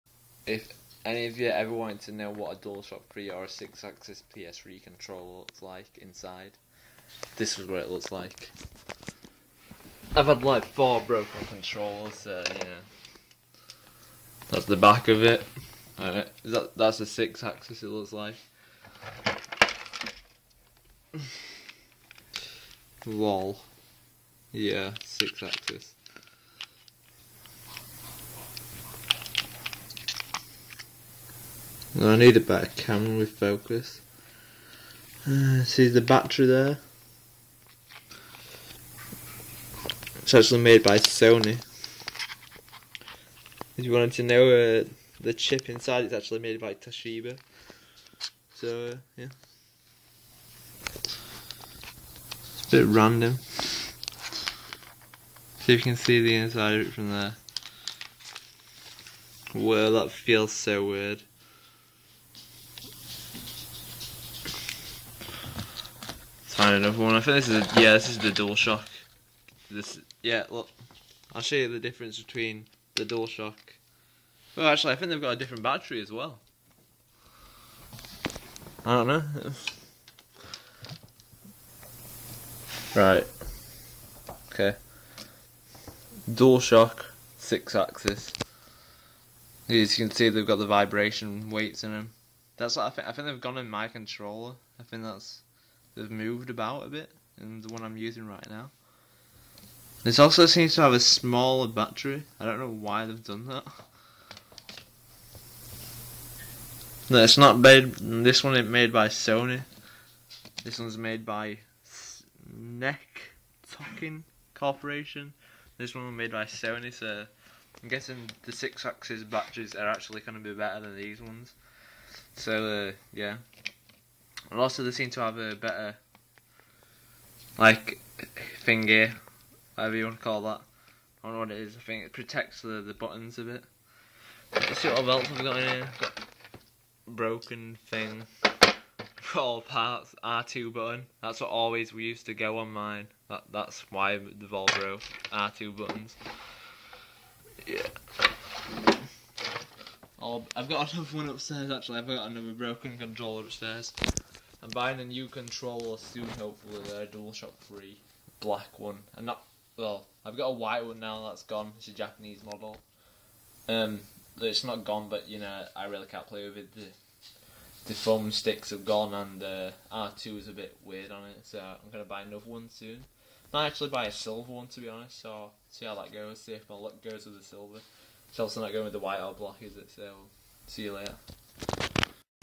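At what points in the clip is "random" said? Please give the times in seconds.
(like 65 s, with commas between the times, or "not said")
52 s.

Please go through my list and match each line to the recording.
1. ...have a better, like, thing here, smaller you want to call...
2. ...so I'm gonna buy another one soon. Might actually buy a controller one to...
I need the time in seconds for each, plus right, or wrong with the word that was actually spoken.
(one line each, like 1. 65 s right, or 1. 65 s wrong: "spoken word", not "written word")
1. 125 s wrong: "whatever", not "smaller"
2. 171 s wrong: "silver", not "controller".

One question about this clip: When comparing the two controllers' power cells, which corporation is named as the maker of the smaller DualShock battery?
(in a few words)
NEC Tokin Corporation.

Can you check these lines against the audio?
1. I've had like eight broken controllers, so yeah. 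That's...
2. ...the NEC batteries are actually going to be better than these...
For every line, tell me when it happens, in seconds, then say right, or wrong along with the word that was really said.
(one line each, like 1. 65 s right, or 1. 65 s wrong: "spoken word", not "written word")
1. 10 s wrong: "four", not "eight"
2. 118 s wrong: "Sixaxis", not "NEC".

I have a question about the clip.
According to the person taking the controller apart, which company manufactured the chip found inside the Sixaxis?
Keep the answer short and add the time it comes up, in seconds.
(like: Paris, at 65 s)
Toshiba, at 46 s.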